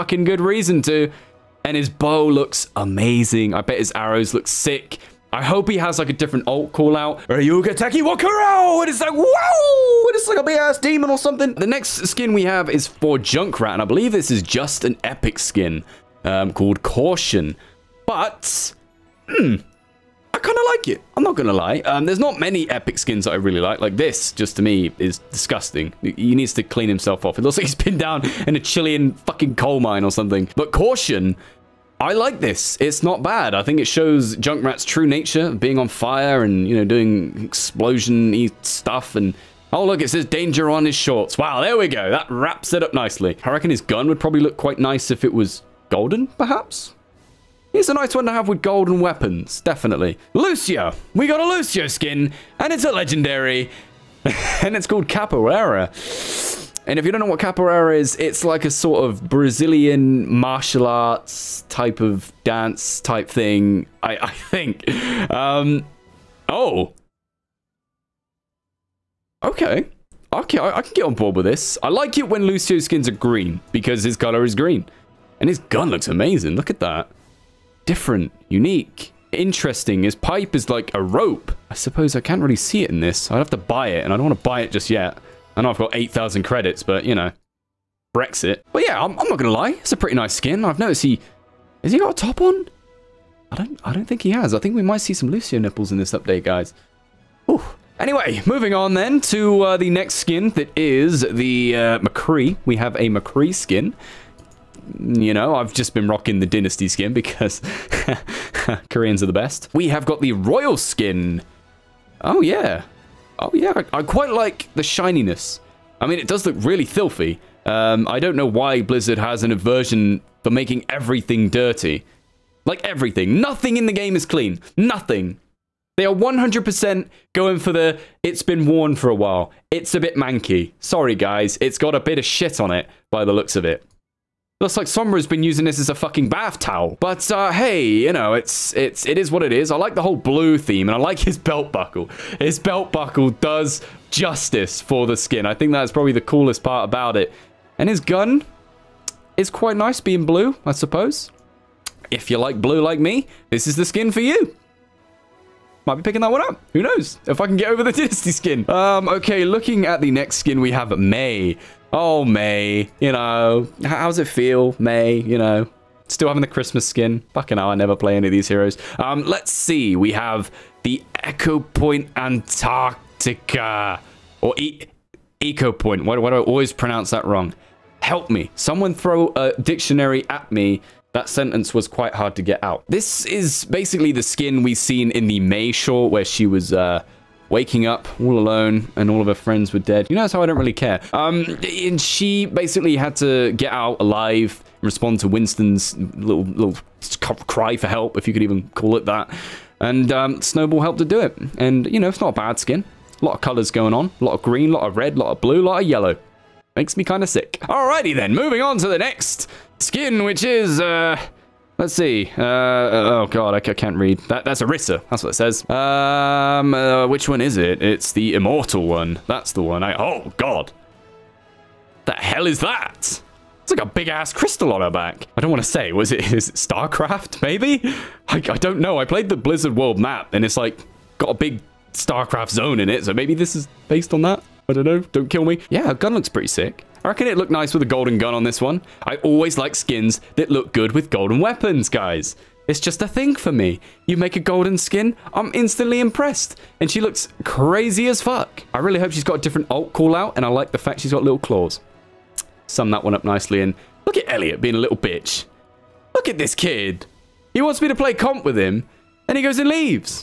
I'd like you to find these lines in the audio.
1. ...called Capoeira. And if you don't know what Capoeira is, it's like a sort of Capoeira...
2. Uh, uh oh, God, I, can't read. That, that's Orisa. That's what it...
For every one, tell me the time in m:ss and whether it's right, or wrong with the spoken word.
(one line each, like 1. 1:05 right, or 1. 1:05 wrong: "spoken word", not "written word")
1. 0:54 wrong: "Brazilian", not "Capoeira"
2. 3:32 right.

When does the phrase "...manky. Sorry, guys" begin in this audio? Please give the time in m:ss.
2:10.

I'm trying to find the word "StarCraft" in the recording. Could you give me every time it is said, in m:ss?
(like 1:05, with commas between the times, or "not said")
3:46, 3:51.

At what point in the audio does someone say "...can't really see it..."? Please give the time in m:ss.
1:22.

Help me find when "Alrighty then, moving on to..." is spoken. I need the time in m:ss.
3:27.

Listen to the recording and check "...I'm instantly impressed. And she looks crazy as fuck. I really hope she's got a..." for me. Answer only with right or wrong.
right.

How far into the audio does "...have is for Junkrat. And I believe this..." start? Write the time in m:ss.
0:12.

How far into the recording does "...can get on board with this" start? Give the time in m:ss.
1:10.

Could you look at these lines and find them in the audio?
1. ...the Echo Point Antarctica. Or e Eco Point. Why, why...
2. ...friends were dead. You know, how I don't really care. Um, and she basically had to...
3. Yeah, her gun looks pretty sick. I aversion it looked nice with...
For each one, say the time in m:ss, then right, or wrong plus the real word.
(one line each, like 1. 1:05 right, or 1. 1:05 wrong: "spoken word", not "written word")
1. 2:50 right
2. 3:09 right
3. 3:55 wrong: "reckon", not "aversion".